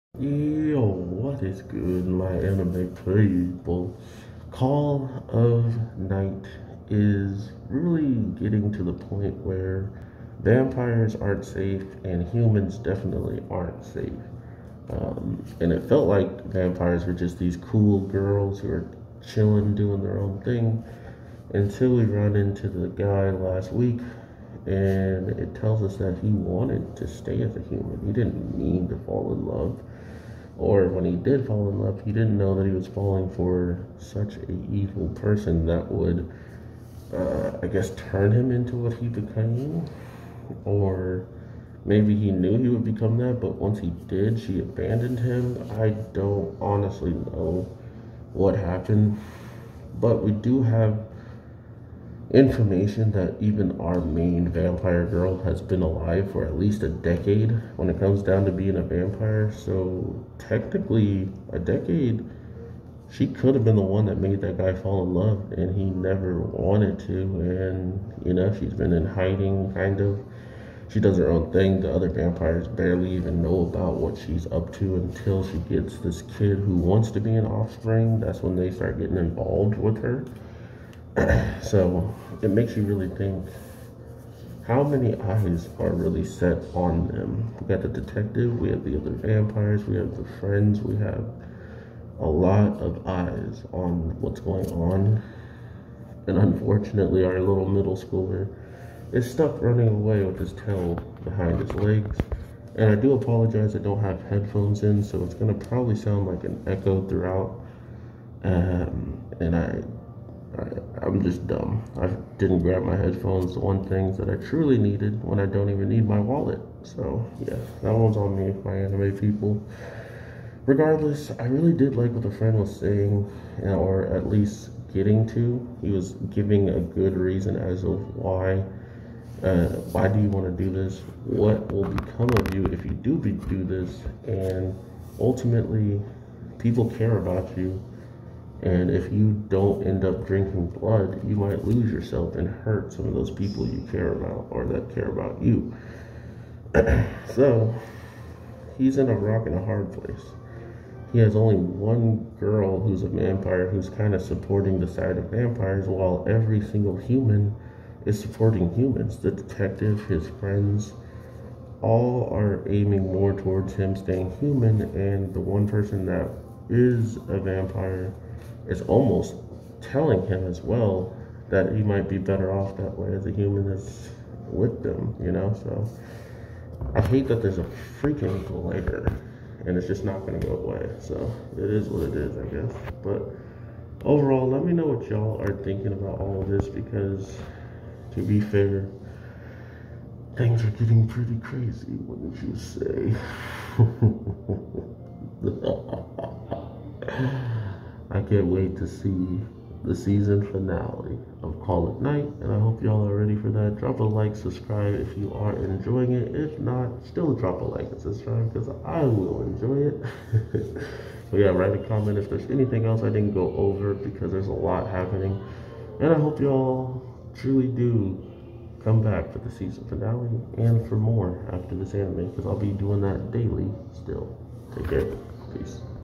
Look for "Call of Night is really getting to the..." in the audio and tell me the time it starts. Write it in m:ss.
0:04.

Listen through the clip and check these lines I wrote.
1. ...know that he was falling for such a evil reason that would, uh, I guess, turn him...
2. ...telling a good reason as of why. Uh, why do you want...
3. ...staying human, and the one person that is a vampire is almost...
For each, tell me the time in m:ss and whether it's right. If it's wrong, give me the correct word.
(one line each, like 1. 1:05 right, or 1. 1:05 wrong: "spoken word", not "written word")
1. 0:32 wrong: "person", not "reason"
2. 2:06 wrong: "giving", not "telling"
3. 2:43 right.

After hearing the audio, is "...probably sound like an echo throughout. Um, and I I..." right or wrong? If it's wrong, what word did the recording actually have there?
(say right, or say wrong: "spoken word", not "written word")
right.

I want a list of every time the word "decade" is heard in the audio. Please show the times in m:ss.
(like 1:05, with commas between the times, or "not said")
0:56, 1:01.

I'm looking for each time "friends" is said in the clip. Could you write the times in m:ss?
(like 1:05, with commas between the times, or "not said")
1:30, 2:02, 2:40.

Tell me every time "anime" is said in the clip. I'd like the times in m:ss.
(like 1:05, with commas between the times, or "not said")
0:02, 1:58, 3:41.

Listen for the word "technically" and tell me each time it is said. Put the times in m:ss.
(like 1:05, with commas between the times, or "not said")
1:00.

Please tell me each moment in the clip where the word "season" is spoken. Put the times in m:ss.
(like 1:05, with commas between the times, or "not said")
3:19, 3:39.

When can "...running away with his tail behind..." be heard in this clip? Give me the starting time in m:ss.
1:39.